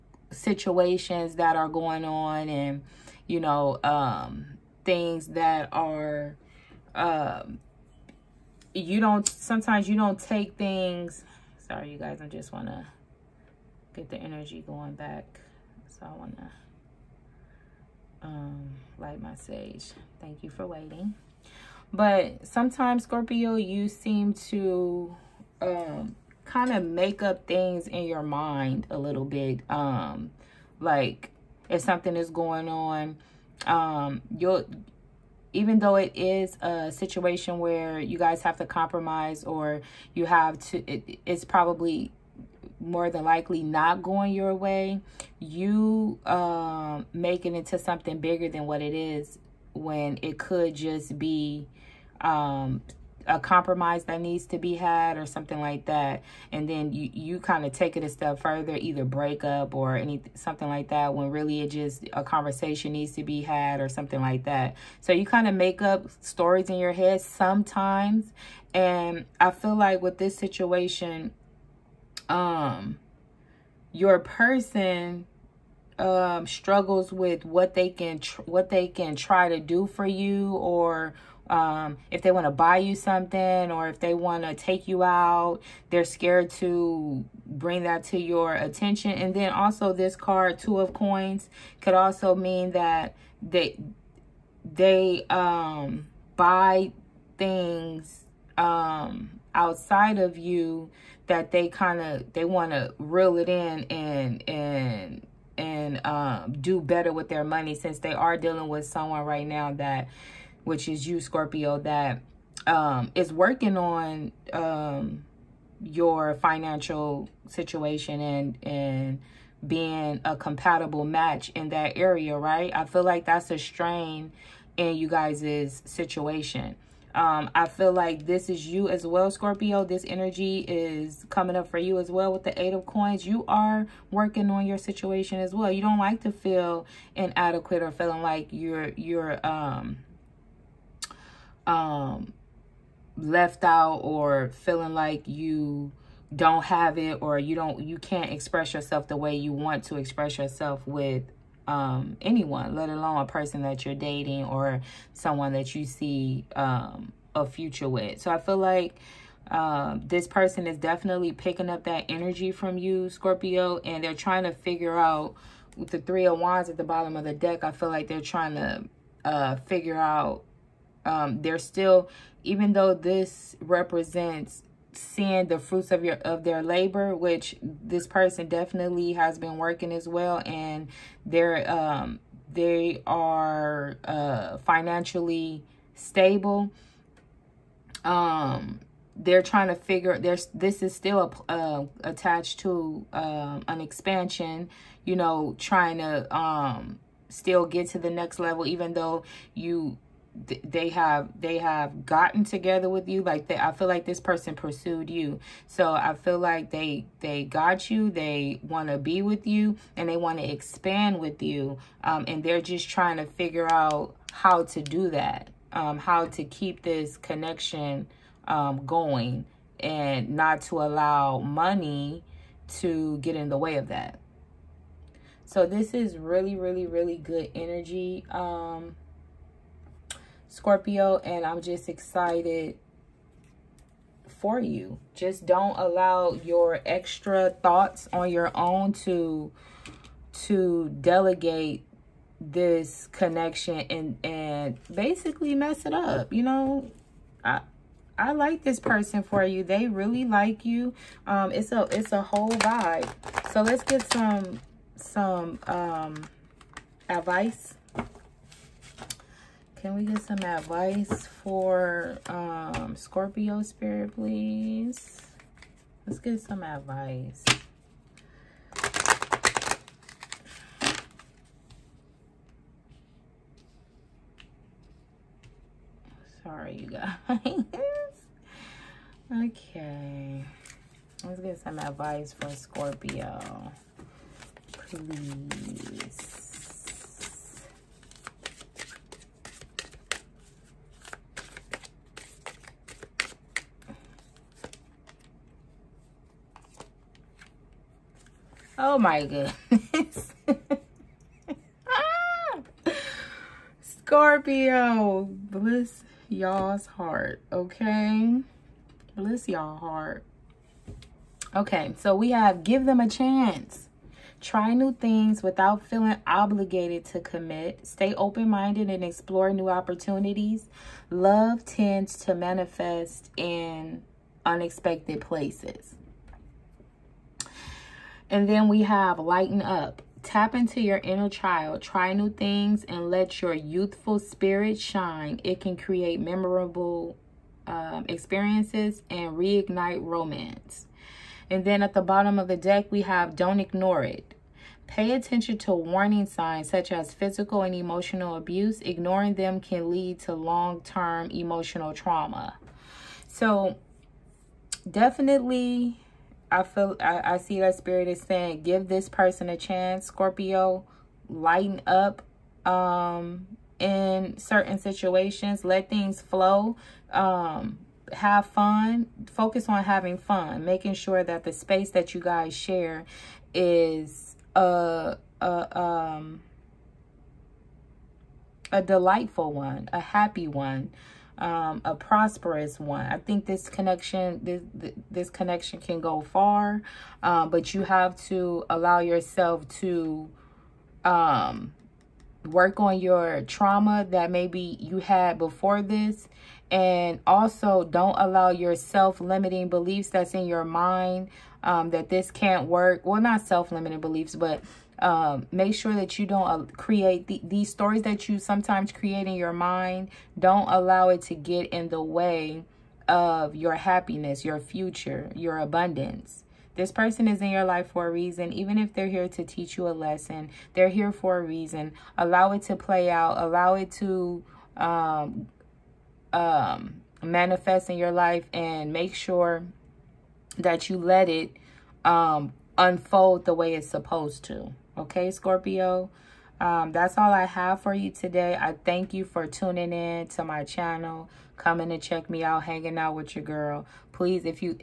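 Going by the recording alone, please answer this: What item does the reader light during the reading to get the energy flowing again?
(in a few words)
Sage.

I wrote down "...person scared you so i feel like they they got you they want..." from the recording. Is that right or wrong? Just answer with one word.
wrong.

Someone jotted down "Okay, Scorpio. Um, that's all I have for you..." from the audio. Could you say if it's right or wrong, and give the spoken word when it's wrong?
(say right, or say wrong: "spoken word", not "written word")
right.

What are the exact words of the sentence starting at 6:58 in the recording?
Even if they're here to teach you a lesson, they're here for a reason.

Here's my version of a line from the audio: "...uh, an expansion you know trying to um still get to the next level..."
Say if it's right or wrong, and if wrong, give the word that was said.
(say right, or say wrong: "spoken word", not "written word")
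right.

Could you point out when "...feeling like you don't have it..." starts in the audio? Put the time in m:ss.
2:24.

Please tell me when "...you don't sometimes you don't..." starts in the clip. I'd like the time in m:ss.
0:08.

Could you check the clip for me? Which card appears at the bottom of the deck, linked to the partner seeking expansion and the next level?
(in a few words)
Three of Wands.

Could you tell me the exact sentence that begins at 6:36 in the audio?
And also don't allow your self-limiting beliefs that's in your mind um, that this can't work.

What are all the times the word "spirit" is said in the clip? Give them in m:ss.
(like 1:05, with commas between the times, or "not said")
4:23, 5:34, 5:57.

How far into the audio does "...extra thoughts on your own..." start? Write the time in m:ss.
3:56.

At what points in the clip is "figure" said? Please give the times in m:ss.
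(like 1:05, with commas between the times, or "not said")
2:44, 2:49, 3:09, 3:33.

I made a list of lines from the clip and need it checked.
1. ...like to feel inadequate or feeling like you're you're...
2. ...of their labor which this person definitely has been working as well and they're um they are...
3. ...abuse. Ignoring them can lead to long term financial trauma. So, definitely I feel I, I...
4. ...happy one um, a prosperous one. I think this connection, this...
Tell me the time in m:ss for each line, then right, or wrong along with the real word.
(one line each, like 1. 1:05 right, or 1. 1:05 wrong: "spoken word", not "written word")
1. 2:15 right
2. 2:56 right
3. 5:48 wrong: "emotional", not "financial"
4. 6:20 right.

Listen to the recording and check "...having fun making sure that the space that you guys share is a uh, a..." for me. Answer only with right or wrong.
right.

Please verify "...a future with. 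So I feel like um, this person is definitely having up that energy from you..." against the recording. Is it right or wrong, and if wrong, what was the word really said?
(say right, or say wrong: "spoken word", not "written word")
wrong: "picking", not "having".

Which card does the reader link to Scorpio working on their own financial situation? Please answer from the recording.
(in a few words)
Eight of Coins.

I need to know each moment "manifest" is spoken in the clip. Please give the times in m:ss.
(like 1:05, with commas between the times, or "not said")
5:22, 7:07.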